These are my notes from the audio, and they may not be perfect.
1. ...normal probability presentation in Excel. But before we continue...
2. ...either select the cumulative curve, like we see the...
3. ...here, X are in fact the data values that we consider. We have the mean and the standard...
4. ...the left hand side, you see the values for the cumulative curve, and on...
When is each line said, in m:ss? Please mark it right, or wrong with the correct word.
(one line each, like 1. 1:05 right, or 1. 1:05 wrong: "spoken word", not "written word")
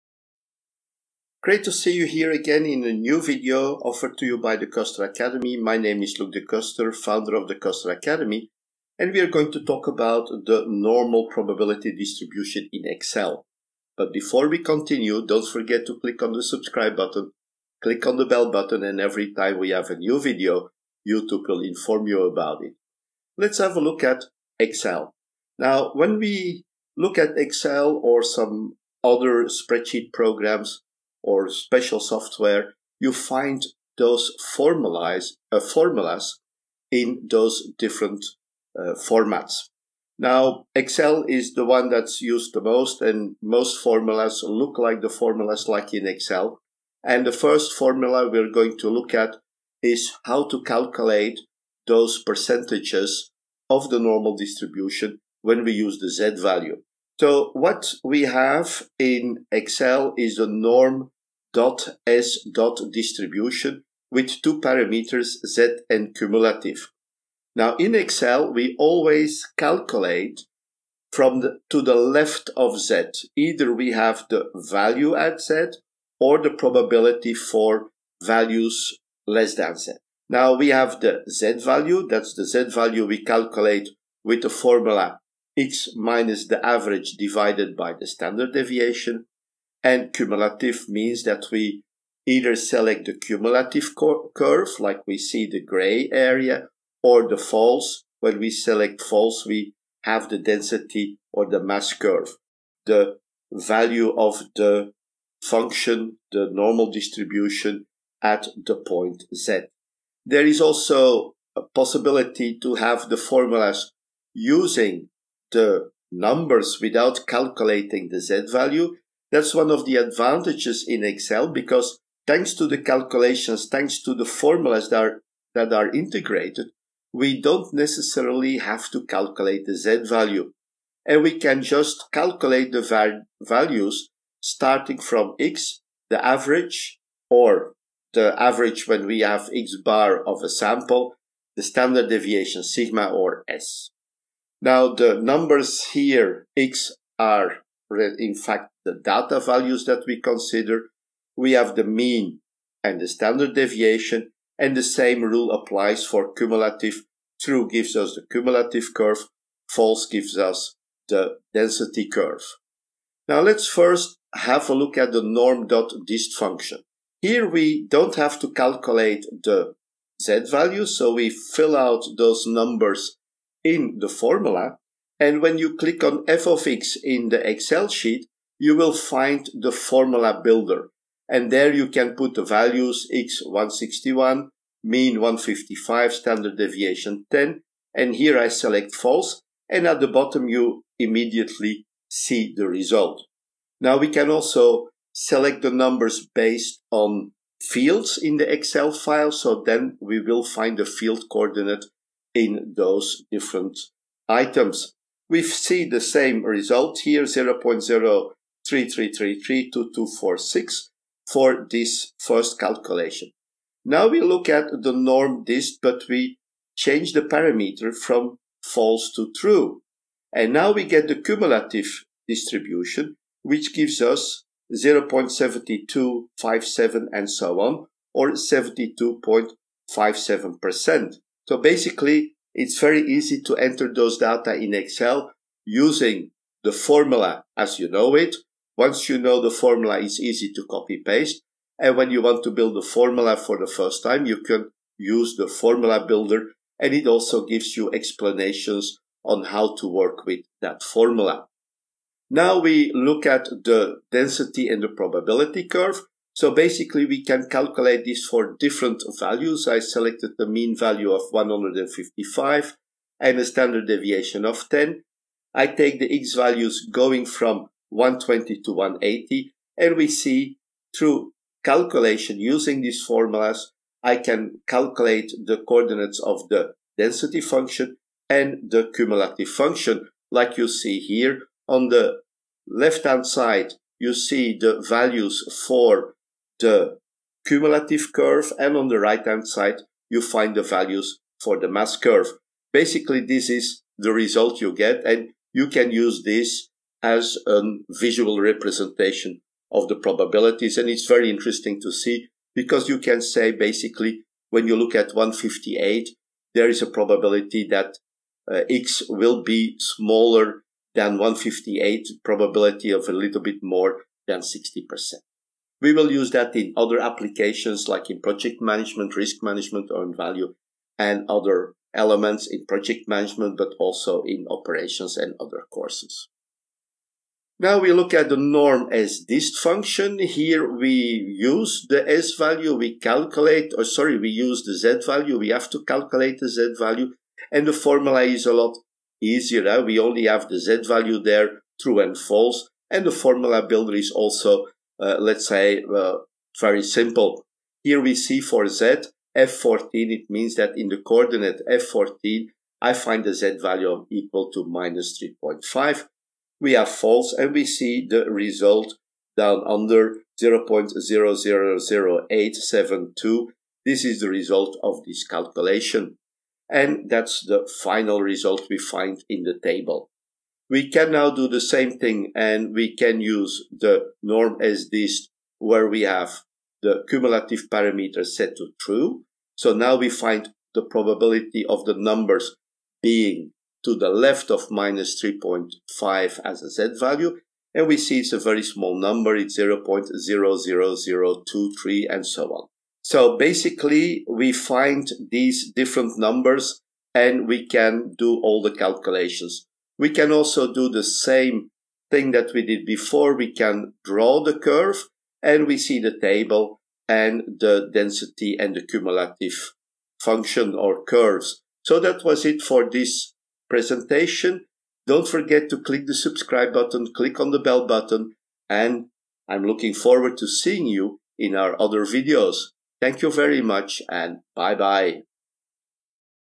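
1. 0:10 wrong: "distribution", not "presentation"
2. 1:32 right
3. 2:25 right
4. 4:41 right.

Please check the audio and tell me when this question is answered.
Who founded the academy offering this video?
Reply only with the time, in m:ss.
0:06.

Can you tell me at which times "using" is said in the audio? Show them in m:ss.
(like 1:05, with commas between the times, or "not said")
1:54, 3:55, 4:32.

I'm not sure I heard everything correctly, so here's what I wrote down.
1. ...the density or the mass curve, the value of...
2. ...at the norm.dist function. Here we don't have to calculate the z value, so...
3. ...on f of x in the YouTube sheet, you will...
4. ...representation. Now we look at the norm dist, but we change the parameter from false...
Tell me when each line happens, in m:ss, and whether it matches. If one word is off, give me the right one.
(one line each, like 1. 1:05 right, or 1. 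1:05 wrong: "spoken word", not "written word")
1. 1:40 right
2. 2:44 right
3. 2:56 wrong: "Excel", not "YouTube"
4. 3:32 wrong: "calculation", not "representation".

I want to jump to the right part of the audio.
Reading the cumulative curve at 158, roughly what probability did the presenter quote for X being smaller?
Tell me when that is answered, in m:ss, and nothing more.
5:13.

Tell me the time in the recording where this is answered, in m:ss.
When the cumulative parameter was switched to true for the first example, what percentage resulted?
3:48.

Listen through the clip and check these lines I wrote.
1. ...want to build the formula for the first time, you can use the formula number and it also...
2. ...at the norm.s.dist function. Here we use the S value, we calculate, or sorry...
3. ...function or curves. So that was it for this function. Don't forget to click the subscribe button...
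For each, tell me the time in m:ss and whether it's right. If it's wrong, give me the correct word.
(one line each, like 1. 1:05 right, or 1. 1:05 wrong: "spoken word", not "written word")
1. 4:02 wrong: "builder", not "number"
2. 5:28 right
3. 6:50 wrong: "presentation", not "function".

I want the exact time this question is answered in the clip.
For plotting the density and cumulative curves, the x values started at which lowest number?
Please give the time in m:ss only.
4:27.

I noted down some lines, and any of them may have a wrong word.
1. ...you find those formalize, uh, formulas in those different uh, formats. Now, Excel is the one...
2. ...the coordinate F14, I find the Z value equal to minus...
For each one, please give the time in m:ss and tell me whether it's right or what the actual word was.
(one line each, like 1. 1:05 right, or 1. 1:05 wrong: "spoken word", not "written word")
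1. 0:32 right
2. 5:50 right.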